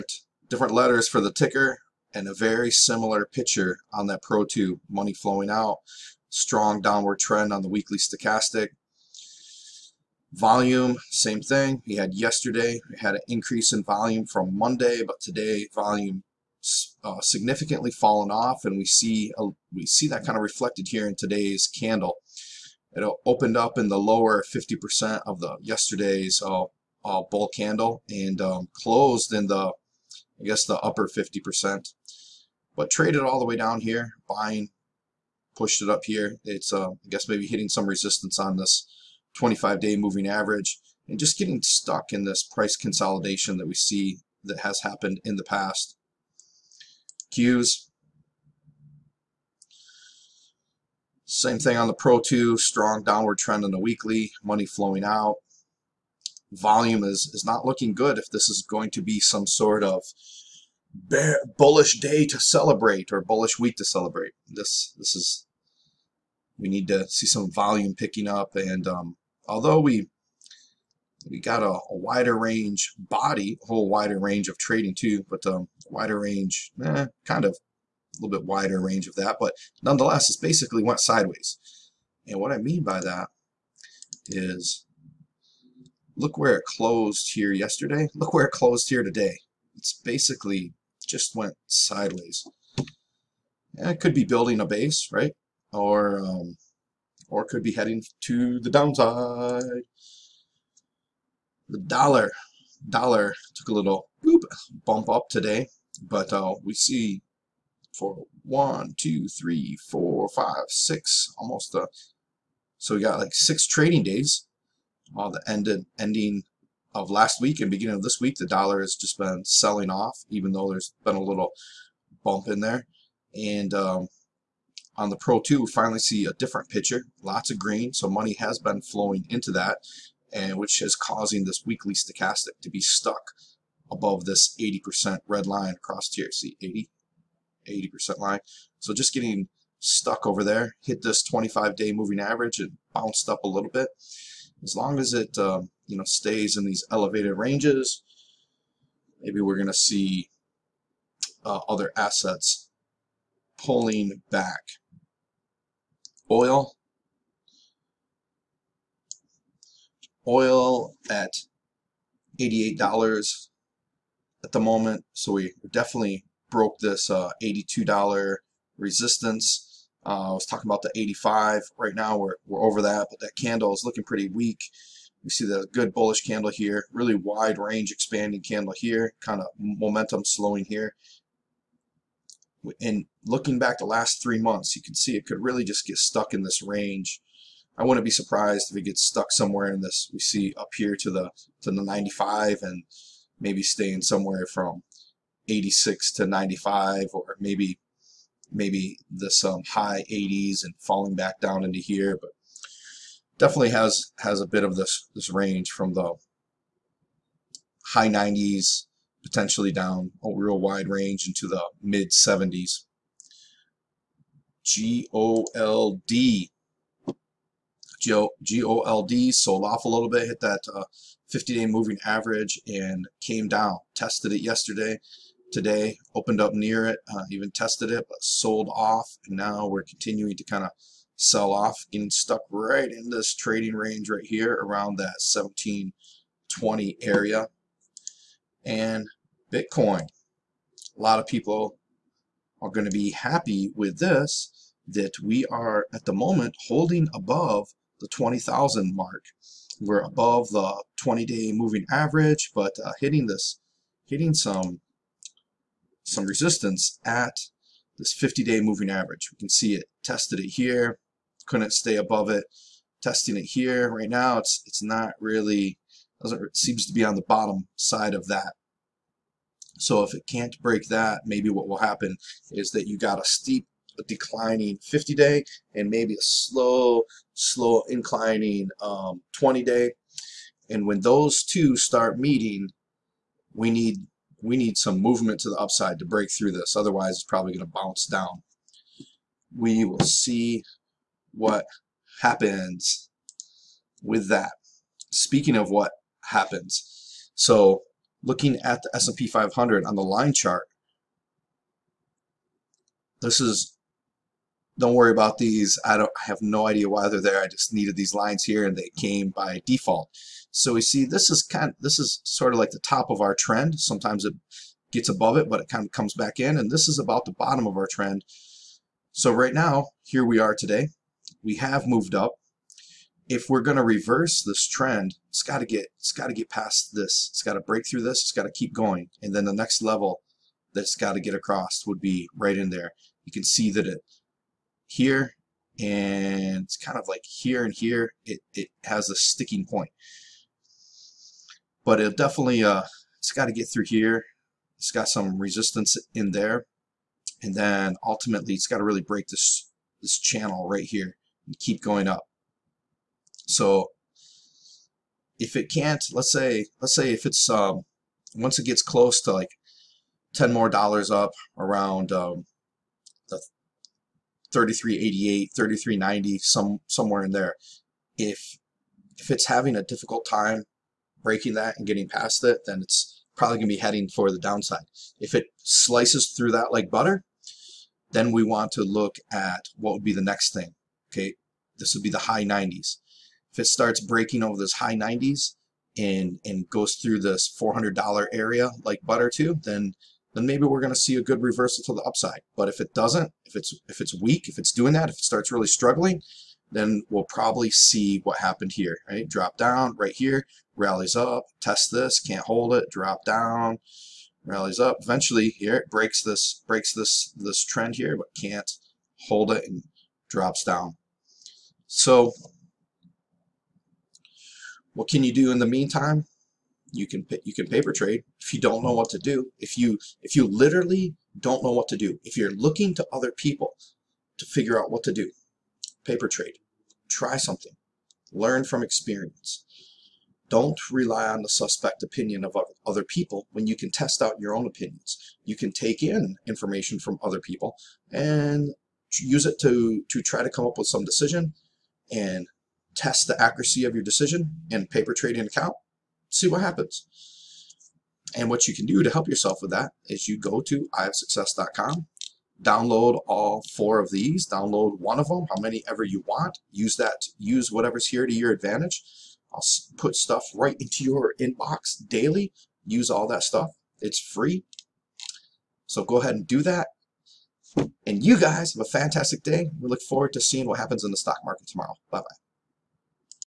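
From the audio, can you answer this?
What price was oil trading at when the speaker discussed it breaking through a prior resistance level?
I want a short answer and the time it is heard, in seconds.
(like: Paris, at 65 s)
$88, at 162 s.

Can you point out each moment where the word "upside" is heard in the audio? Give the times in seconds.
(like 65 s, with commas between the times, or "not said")
285 s, 392 s.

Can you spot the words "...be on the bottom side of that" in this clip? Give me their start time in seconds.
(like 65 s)
266 s.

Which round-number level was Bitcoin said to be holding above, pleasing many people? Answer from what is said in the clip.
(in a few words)
20,000.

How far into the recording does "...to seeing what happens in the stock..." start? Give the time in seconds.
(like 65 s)
470 s.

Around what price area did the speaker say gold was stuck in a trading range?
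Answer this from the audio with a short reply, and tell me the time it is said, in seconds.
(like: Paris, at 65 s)
1720, at 235 s.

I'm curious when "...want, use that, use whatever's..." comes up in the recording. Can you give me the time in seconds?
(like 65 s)
456 s.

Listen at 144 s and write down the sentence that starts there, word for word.
As long as it um, you know stays in these elevated ranges, maybe we're going to see uh, other assets pulling back.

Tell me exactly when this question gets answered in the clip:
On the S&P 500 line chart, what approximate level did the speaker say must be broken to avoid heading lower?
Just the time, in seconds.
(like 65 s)
364 s.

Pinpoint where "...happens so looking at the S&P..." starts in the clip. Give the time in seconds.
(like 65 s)
296 s.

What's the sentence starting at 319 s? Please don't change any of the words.
So right now, here we are today.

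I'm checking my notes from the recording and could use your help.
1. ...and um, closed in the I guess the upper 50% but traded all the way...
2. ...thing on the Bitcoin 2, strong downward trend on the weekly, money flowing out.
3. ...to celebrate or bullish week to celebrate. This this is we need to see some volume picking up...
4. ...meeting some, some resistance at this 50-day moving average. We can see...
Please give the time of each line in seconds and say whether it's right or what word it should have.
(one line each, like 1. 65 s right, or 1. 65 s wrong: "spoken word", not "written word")
1. 28 s right
2. 51 s wrong: "Pro", not "Bitcoin"
3. 62 s right
4. 254 s wrong: "hitting", not "meeting".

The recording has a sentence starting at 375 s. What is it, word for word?
If it slices through that like butter, then we want to look at what would be the next thing.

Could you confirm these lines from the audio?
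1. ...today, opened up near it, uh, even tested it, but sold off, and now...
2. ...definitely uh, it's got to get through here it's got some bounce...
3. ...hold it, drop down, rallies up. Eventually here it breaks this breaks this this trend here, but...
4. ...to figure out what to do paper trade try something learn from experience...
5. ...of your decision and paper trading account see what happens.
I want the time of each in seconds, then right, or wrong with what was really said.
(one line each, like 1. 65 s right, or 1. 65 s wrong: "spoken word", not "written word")
1. 225 s right
2. 342 s wrong: "resistance", not "bounce"
3. 402 s right
4. 424 s right
5. 443 s right.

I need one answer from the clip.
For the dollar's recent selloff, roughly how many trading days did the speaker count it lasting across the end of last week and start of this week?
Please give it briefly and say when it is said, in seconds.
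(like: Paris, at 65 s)
6, at 113 s.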